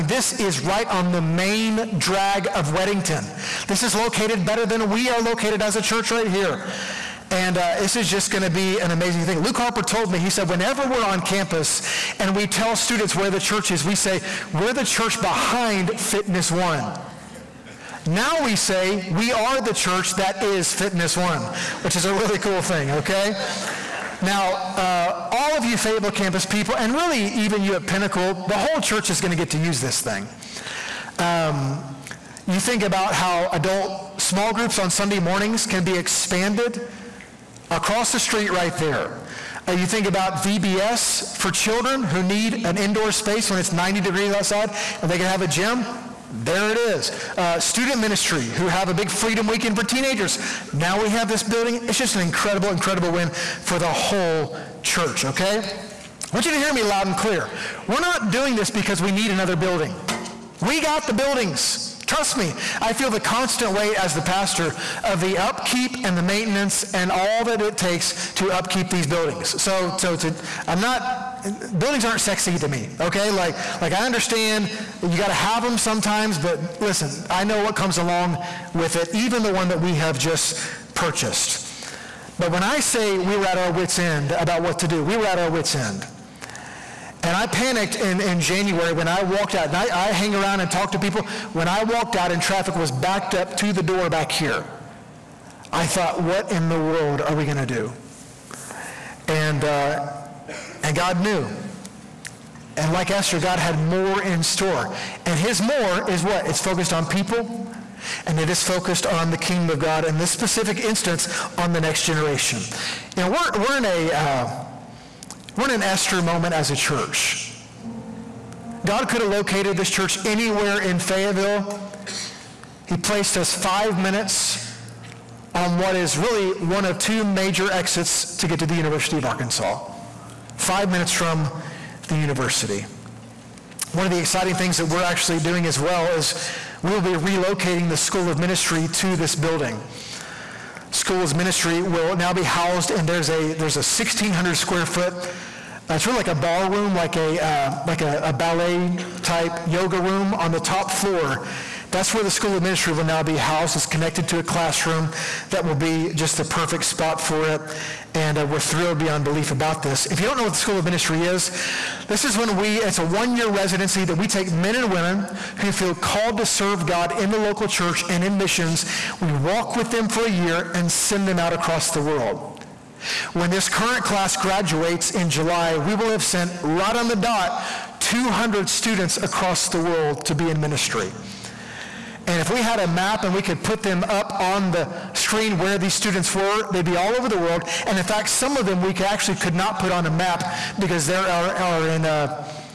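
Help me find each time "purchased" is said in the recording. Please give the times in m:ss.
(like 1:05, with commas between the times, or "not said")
1:20.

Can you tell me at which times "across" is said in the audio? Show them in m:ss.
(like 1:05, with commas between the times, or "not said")
0:37, 2:51, 2:59.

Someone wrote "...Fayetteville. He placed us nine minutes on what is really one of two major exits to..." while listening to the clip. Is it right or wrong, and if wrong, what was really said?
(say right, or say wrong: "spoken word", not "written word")
wrong: "five", not "nine".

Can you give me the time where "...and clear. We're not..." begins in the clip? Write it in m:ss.
0:57.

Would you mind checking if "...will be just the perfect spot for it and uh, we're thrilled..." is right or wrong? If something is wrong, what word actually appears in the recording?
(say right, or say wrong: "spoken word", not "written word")
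right.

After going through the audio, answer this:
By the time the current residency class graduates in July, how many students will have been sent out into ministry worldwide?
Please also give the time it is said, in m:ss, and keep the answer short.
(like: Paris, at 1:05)
200, at 2:58.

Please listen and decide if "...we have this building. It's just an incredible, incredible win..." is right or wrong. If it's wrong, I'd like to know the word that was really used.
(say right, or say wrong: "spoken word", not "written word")
right.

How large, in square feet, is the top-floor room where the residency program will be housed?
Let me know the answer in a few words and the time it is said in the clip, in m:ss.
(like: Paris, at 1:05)
1,600 square feet, at 2:23.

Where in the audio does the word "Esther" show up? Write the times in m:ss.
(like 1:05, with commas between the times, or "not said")
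1:43, 1:55.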